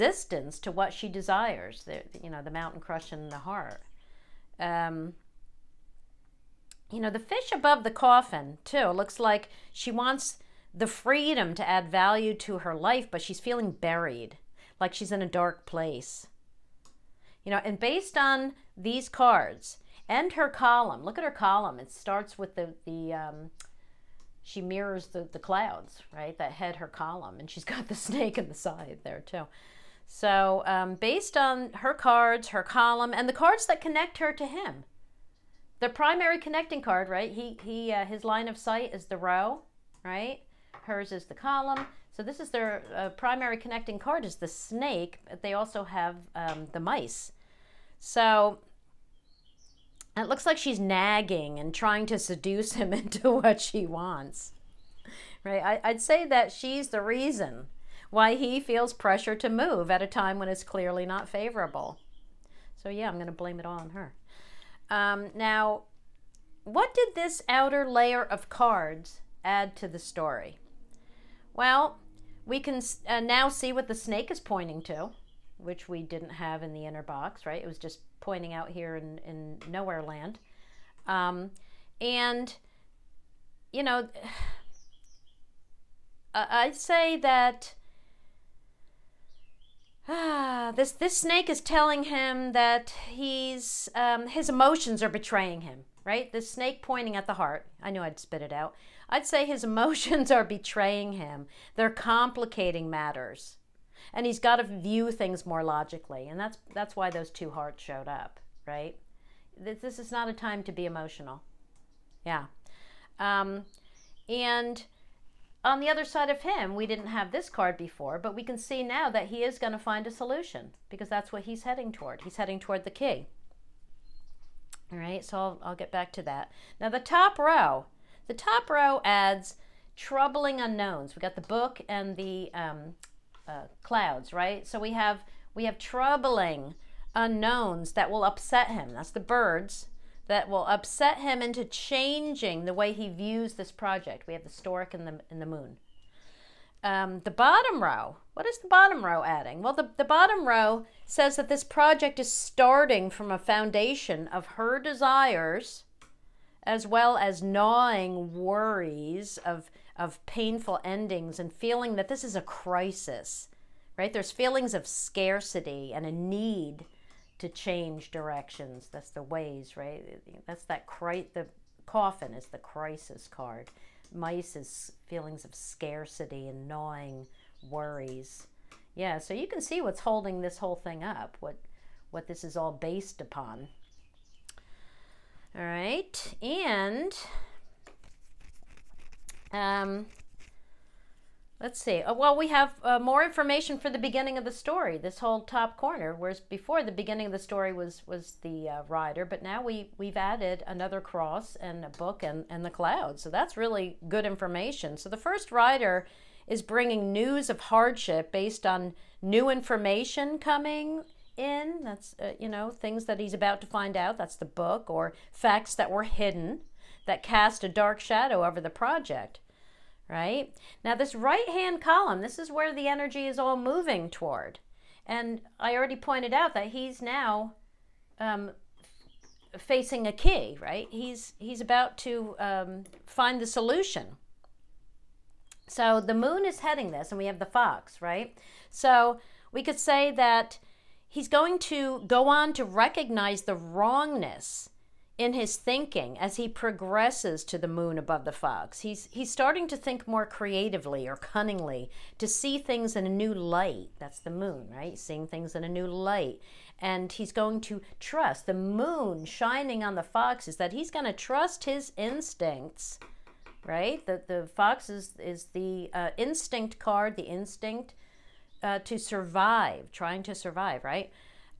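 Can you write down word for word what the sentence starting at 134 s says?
So we have we have troubling unknowns that will upset him.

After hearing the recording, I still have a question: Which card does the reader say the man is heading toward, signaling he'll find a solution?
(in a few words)
The key.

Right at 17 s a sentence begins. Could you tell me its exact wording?
You know, and based on these cards and her column, look at her column.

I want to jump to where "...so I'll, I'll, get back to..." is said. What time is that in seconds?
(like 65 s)
125 s.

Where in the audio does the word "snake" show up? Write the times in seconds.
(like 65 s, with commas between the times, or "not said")
27 s, 44 s, 73 s, 91 s, 96 s.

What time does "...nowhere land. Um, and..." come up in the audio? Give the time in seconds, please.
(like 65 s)
79 s.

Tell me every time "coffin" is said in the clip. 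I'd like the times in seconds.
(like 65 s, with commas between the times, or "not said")
7 s, 171 s.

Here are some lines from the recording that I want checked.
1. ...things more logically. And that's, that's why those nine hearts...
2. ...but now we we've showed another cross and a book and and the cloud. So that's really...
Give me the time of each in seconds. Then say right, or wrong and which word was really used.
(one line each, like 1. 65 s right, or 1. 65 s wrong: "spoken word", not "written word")
1. 105 s wrong: "two", not "nine"
2. 199 s wrong: "added", not "showed".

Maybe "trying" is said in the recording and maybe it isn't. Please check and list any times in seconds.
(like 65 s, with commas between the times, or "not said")
51 s, 269 s.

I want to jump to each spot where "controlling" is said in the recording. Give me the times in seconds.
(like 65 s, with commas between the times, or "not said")
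not said.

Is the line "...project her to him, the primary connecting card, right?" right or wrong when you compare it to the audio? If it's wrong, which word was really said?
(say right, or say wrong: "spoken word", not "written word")
wrong: "connect", not "project".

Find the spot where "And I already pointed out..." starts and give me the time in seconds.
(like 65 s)
225 s.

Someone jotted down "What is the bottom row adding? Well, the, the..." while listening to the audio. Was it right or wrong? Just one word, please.
right.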